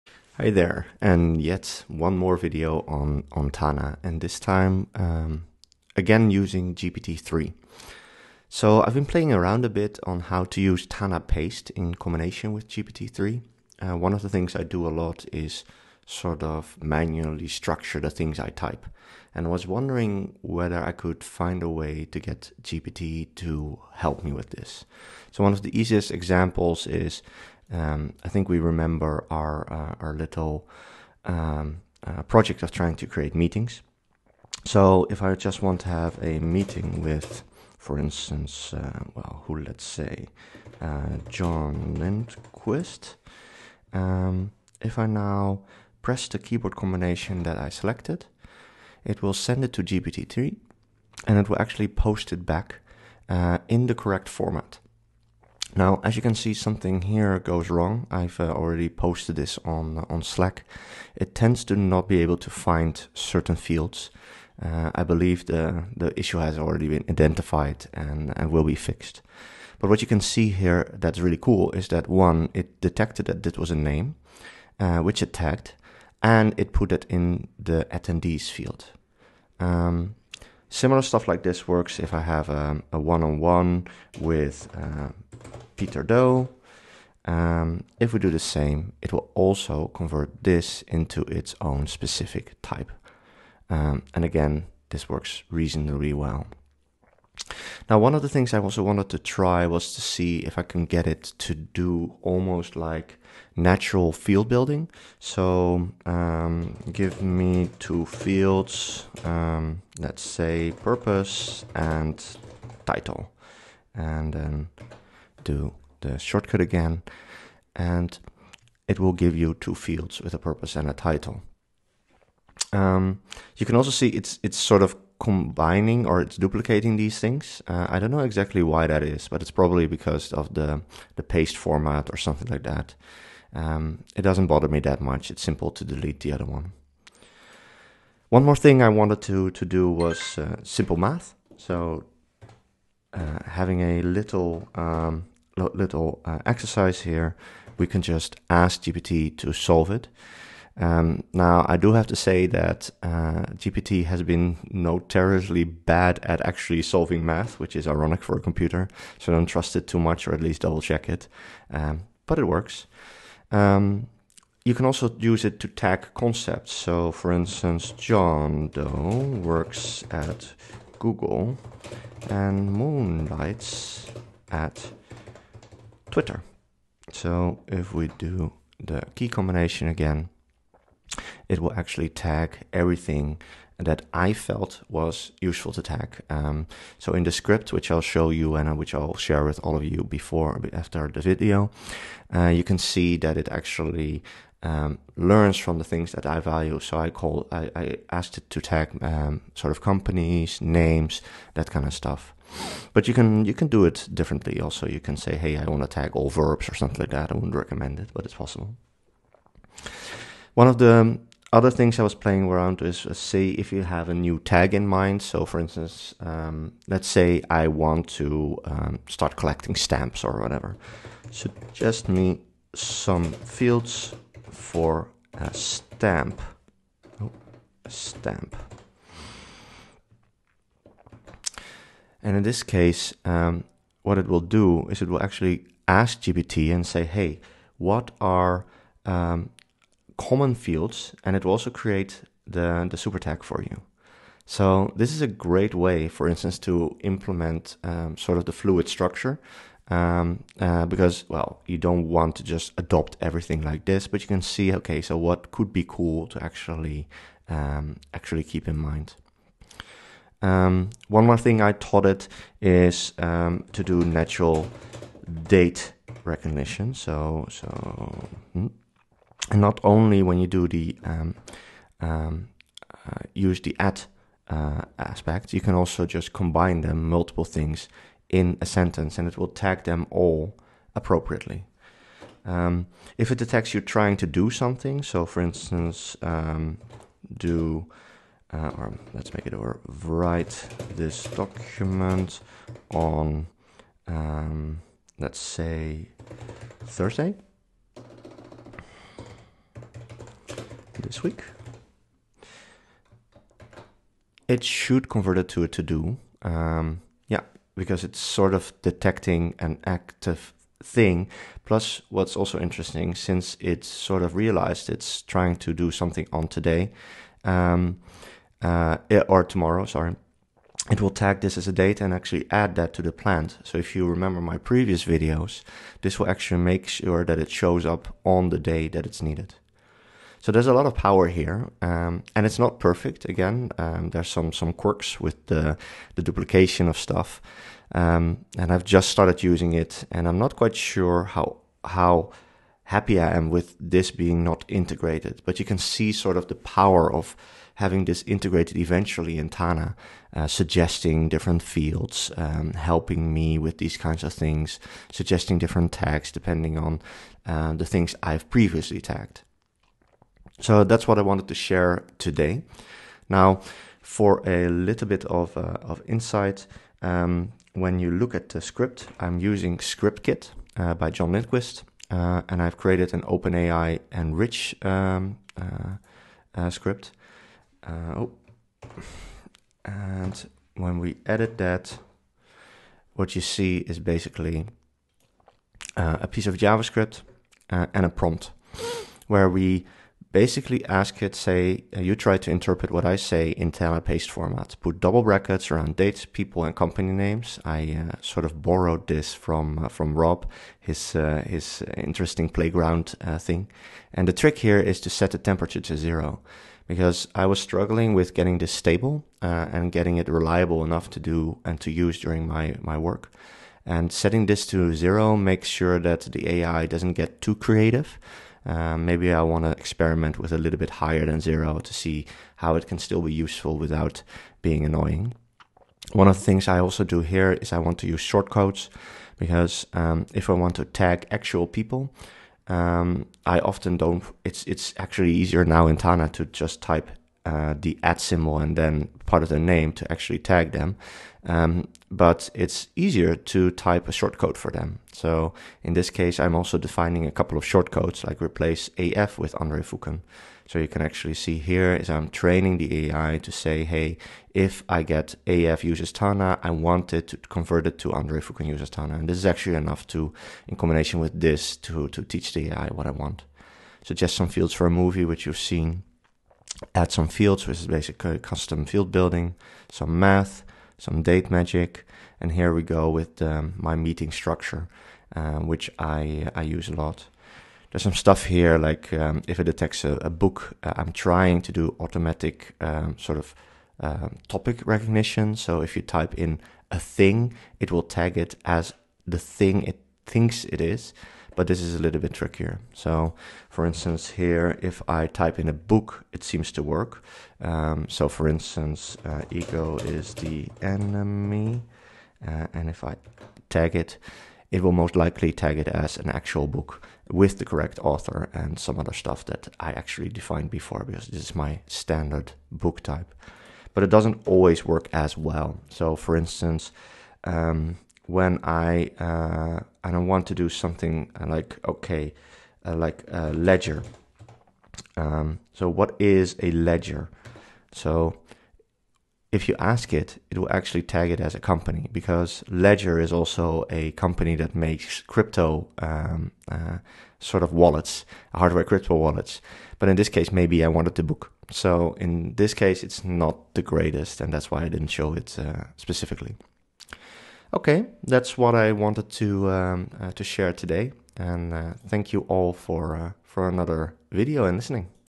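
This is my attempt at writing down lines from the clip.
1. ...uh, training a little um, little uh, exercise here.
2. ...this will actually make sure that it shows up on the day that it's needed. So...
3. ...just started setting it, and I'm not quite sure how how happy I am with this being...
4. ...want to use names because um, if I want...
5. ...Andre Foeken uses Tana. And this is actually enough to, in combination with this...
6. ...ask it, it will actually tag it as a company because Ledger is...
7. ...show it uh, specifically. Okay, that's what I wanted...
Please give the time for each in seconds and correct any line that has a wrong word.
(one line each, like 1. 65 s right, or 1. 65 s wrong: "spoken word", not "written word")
1. 143 s wrong: "having", not "training"
2. 326 s right
3. 338 s wrong: "using", not "setting"
4. 427 s wrong: "shortcodes", not "names"
5. 458 s right
6. 529 s right
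7. 545 s right.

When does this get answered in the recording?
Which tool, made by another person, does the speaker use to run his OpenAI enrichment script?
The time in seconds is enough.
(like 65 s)
369 s.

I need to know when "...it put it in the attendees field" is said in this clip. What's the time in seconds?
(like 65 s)
76 s.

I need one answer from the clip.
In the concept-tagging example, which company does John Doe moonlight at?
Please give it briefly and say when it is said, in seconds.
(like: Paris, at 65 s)
Twitter, at 176 s.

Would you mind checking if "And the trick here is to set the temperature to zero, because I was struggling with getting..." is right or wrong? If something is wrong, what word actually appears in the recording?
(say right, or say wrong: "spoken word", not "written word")
right.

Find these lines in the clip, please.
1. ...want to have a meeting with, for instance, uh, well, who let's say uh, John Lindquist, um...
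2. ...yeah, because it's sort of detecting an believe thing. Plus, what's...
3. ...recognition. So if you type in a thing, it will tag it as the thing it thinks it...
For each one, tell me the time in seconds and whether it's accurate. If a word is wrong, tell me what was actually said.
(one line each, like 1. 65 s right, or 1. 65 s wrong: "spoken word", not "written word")
1. 35 s right
2. 307 s wrong: "active", not "believe"
3. 484 s right.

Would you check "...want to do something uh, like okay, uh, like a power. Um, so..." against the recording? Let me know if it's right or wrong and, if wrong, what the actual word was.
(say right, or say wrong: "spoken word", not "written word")
wrong: "ledger", not "power".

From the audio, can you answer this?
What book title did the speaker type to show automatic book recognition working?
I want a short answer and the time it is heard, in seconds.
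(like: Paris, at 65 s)
Ego Is the Enemy, at 499 s.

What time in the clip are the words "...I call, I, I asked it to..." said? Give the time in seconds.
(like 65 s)
196 s.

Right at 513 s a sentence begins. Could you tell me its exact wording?
But it doesn't always work as well.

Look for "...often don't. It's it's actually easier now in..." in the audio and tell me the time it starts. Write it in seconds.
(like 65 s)
433 s.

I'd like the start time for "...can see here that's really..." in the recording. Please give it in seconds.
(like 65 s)
70 s.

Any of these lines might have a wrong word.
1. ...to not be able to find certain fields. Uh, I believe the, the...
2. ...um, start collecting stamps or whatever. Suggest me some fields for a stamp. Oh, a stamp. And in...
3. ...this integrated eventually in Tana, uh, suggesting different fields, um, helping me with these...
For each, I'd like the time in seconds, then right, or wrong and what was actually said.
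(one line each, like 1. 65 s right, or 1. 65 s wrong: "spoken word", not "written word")
1. 61 s right
2. 218 s right
3. 348 s right.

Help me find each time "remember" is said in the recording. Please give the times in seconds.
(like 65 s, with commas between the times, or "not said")
28 s, 324 s.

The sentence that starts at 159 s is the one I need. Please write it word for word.
So don't trust it too much, or at least double check it.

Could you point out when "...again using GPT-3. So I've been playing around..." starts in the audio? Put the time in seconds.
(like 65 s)
5 s.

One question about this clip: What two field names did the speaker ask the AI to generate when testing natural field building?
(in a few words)
purpose and title.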